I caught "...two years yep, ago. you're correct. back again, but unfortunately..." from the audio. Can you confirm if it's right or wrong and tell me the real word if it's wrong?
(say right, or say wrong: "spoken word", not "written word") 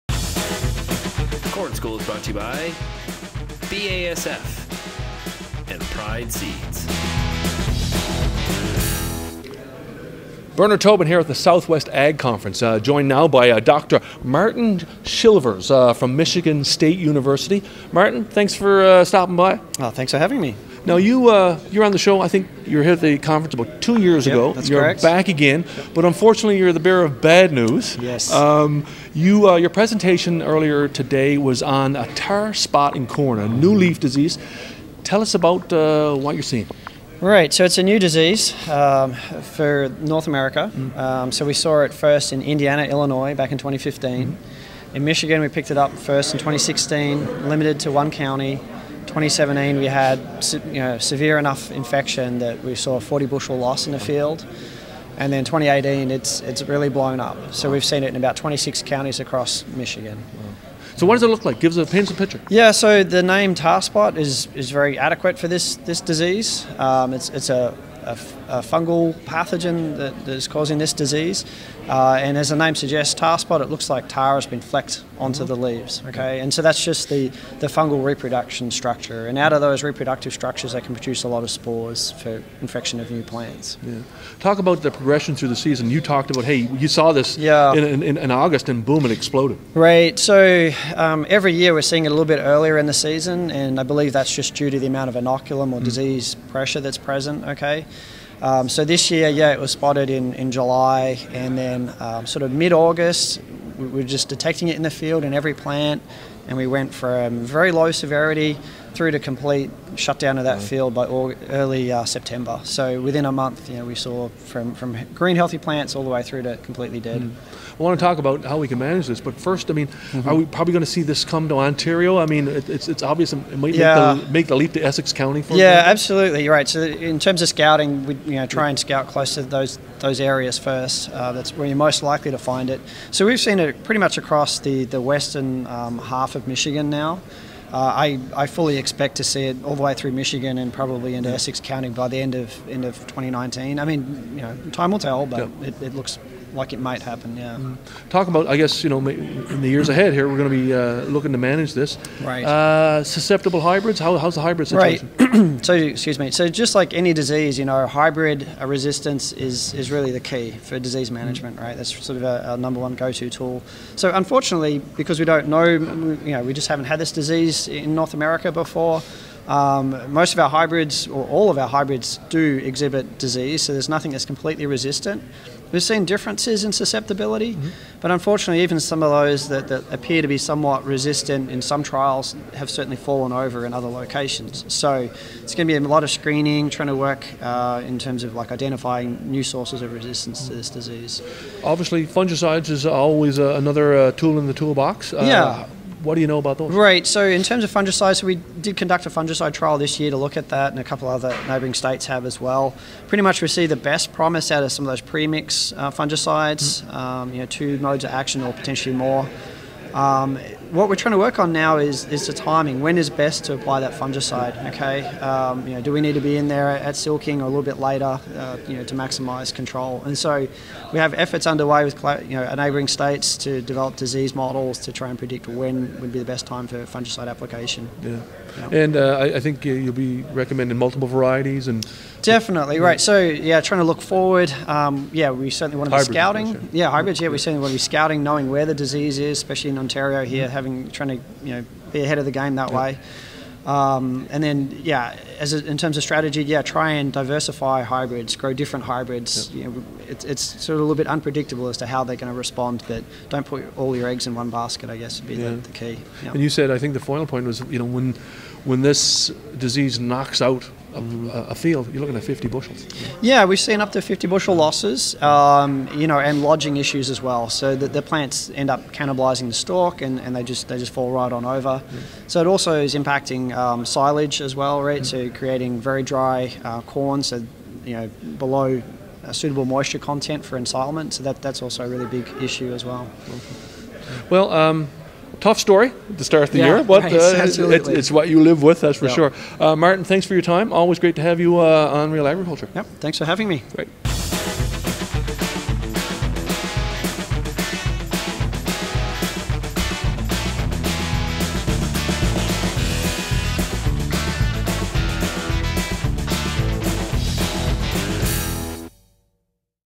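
right.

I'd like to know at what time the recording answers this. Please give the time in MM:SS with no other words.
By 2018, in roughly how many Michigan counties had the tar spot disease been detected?
00:58.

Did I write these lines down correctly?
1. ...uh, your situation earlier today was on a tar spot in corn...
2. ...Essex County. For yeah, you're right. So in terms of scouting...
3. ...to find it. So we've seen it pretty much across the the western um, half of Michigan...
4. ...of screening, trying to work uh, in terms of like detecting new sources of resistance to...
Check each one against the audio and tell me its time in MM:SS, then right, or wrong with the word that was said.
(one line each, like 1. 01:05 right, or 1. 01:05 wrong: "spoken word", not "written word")
1. 00:29 wrong: "presentation", not "situation"
2. 02:04 right
3. 02:12 right
4. 03:06 wrong: "identifying", not "detecting".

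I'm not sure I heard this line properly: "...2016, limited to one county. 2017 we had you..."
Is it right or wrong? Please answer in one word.
right.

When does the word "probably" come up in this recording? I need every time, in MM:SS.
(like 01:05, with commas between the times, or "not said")
02:00, 02:20.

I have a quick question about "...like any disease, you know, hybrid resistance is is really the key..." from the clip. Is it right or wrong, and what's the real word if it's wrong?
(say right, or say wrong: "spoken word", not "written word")
right.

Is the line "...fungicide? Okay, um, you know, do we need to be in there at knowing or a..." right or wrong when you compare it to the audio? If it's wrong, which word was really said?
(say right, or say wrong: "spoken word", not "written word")
wrong: "silking", not "knowing".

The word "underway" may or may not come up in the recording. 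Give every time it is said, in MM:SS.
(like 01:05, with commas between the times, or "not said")
03:41.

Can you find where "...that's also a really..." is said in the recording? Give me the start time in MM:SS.
04:41.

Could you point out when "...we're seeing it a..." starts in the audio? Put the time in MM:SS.
01:31.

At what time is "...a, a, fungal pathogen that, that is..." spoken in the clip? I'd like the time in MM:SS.
01:08.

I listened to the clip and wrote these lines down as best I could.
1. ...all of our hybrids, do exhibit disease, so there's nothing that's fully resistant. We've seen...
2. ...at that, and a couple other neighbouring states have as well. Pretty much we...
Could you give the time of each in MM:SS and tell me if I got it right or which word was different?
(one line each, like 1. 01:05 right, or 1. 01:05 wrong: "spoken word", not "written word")
1. 02:51 wrong: "completely", not "fully"
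2. 03:20 right.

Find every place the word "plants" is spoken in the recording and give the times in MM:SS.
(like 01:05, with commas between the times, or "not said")
01:23, 01:45, 01:55, 04:28.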